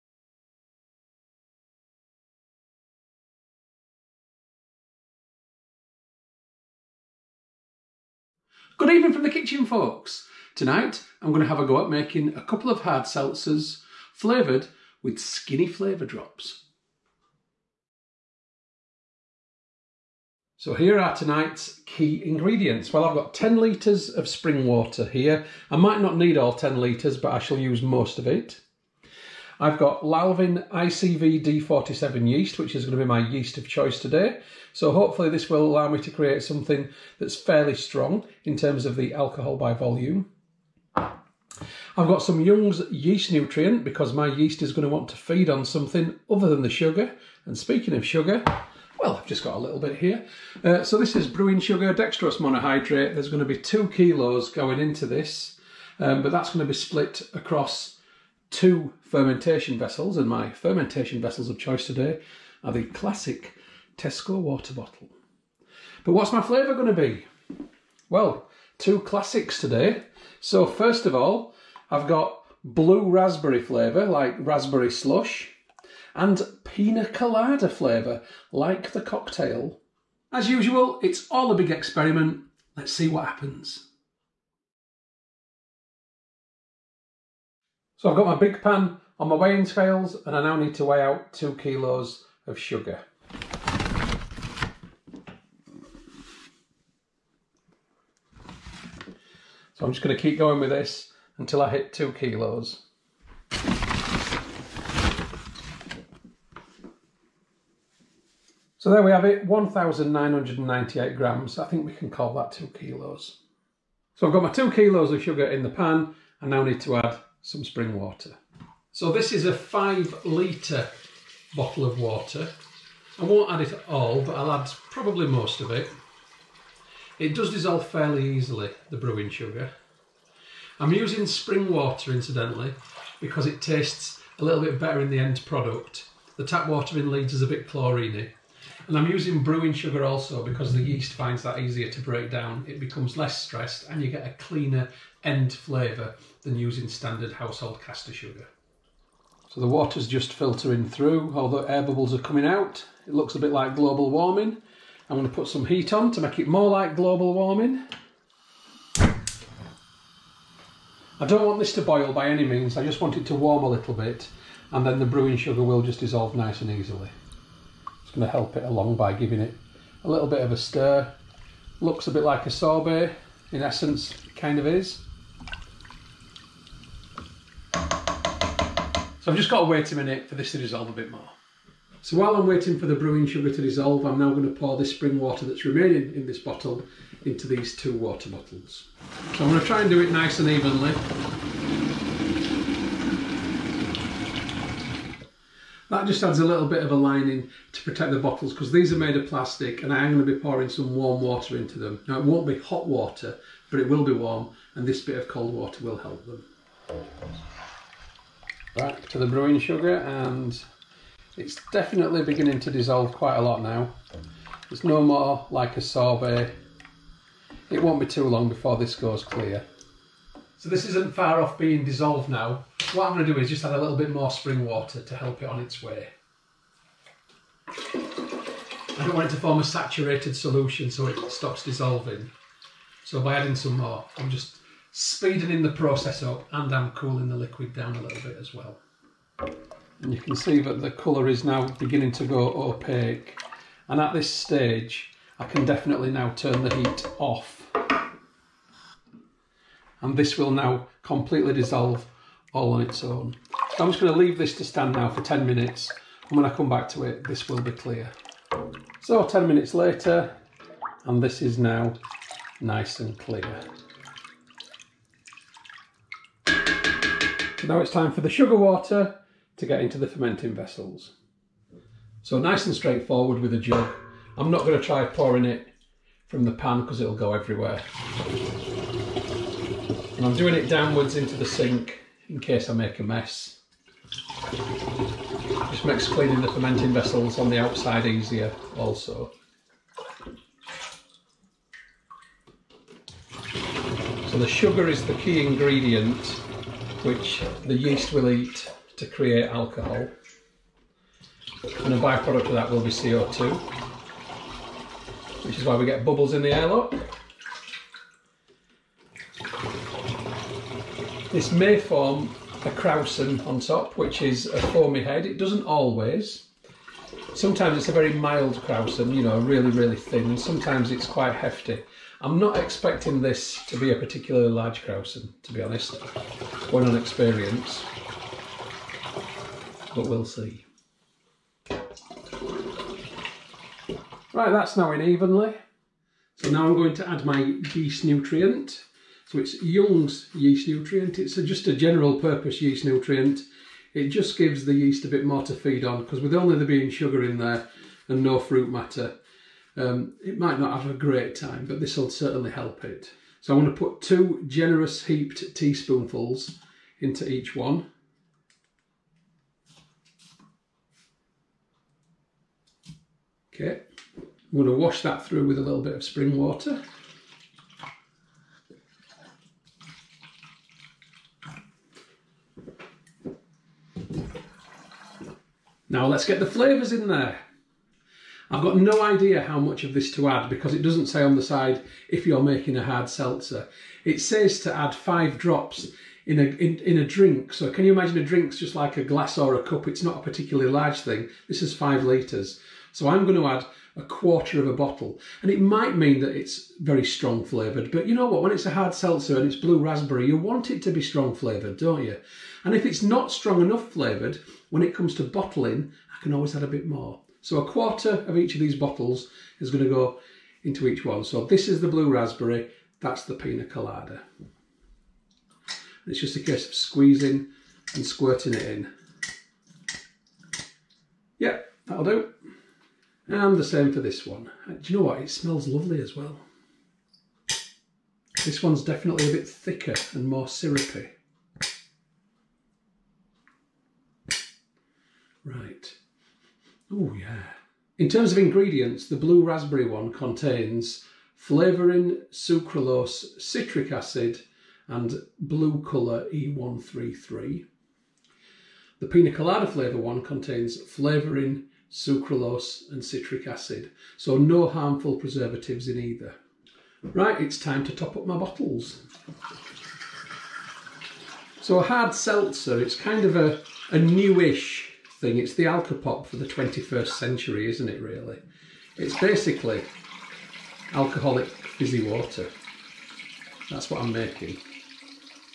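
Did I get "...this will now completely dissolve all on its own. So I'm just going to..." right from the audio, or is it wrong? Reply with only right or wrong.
right.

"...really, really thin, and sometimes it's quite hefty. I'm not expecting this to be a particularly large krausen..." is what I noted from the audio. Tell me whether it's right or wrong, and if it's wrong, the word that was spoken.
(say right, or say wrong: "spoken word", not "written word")
right.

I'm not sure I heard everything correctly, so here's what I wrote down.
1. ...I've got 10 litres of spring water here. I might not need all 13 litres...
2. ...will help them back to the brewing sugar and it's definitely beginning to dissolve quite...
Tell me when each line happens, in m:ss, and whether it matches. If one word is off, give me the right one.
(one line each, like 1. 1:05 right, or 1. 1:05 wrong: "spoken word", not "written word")
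1. 0:23 wrong: "10", not "13"
2. 3:25 right.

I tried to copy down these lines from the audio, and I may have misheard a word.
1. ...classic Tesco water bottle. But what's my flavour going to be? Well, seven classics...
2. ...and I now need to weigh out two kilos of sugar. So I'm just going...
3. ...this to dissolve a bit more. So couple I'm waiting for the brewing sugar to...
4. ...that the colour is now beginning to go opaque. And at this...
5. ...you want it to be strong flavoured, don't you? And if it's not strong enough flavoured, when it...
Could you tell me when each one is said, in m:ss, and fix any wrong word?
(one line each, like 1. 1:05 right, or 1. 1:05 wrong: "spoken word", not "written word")
1. 1:02 wrong: "two", not "seven"
2. 1:30 right
3. 3:00 wrong: "while", not "couple"
4. 4:00 right
5. 6:40 right.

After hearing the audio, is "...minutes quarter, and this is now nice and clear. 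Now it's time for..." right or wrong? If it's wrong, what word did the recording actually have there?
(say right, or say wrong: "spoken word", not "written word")
wrong: "later", not "quarter".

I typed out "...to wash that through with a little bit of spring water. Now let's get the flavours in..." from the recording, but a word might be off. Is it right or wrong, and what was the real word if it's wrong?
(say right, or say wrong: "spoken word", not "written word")
right.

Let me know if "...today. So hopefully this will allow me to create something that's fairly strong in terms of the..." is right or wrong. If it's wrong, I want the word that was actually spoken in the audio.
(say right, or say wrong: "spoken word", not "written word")
right.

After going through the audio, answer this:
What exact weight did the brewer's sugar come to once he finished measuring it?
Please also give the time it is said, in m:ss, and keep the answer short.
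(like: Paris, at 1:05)
1,998 grams, at 1:49.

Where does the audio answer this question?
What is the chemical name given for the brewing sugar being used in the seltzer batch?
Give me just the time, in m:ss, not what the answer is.
0:51.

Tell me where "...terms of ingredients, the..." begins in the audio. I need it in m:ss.
7:18.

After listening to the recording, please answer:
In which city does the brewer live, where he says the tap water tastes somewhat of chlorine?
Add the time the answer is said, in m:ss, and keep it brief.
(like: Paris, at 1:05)
Leeds, at 2:17.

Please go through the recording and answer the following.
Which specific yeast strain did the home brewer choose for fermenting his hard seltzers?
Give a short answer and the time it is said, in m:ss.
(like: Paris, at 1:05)
Lalvin ICV D47, at 0:30.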